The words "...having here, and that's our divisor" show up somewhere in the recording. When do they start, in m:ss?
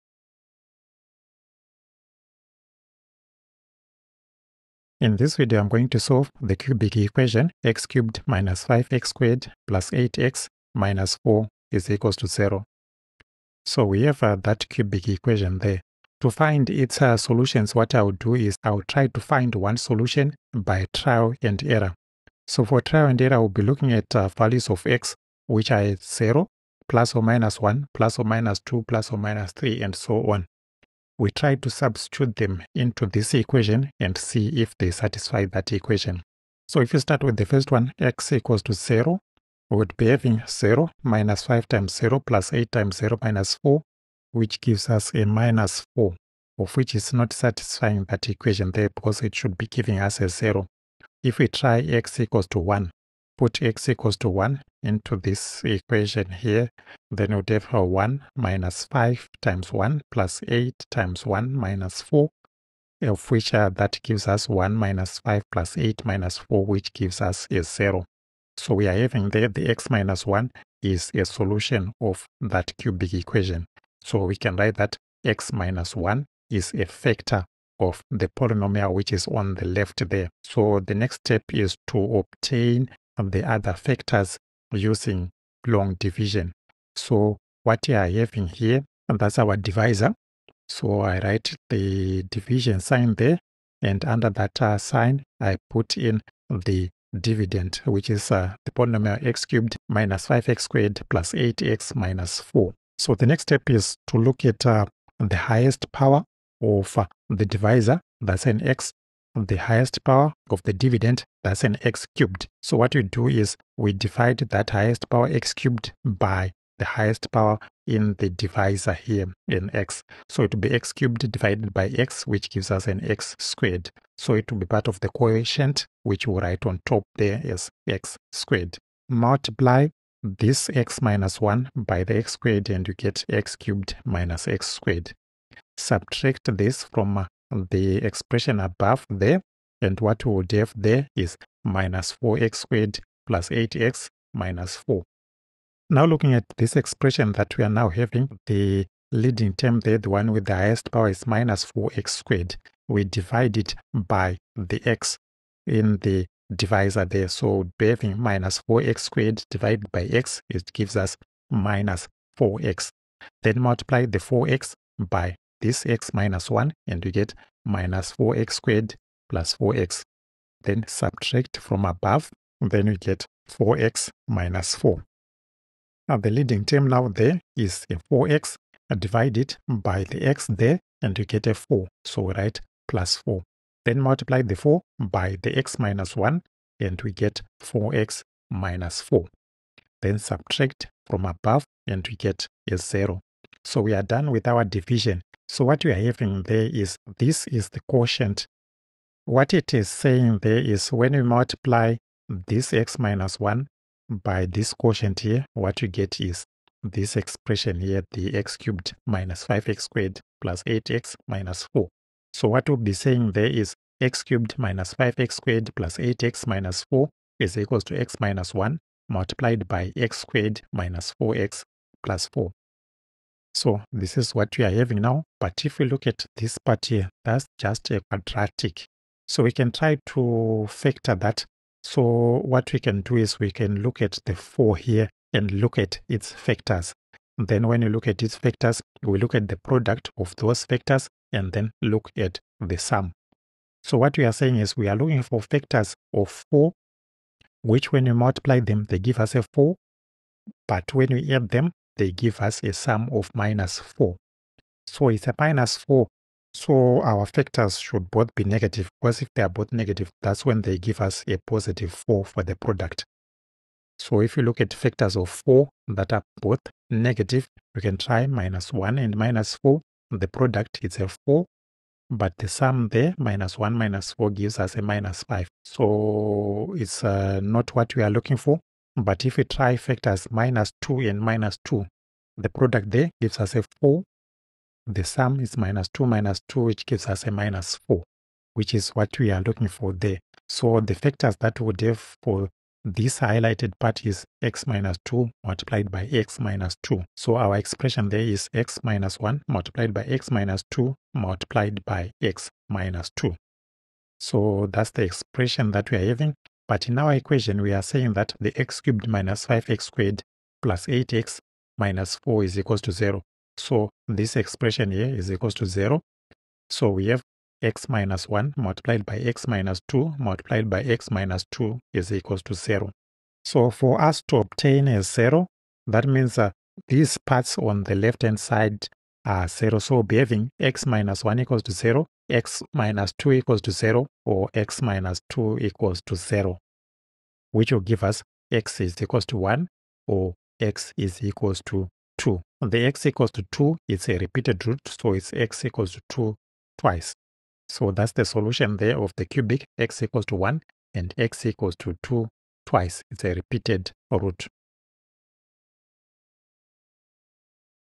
1:28.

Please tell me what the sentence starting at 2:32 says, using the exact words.
We divide it by the x in the divisor there.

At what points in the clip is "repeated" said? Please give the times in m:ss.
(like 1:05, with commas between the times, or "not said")
5:44, 5:53.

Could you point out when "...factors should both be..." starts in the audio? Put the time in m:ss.
4:17.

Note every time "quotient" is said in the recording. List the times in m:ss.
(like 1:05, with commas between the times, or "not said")
2:05, 3:17, 3:24.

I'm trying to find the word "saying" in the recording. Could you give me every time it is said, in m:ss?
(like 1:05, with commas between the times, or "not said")
3:19, 3:32, 4:04, 5:07.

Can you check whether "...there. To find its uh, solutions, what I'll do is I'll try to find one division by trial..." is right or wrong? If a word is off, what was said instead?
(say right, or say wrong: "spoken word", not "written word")
wrong: "solution", not "division".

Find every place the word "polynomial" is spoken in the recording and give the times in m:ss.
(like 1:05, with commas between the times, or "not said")
1:18, 1:38.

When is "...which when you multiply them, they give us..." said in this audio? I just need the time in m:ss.
4:07.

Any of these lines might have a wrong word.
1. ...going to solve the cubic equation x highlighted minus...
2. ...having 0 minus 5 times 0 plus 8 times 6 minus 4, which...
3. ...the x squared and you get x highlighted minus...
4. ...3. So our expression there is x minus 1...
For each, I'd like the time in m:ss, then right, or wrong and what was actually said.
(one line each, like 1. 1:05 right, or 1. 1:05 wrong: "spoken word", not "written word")
1. 0:05 wrong: "cubed", not "highlighted"
2. 0:40 wrong: "0", not "6"
3. 2:12 wrong: "cubed", not "highlighted"
4. 4:56 wrong: "2", not "3".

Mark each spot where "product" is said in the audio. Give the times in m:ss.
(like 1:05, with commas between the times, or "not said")
3:59, 4:22, 4:30, 4:42.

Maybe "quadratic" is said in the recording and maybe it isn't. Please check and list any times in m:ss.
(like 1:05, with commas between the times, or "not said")
3:48.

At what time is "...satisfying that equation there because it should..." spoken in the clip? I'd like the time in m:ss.
0:47.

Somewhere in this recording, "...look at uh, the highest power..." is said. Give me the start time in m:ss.
1:44.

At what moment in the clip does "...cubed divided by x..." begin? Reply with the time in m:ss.
2:00.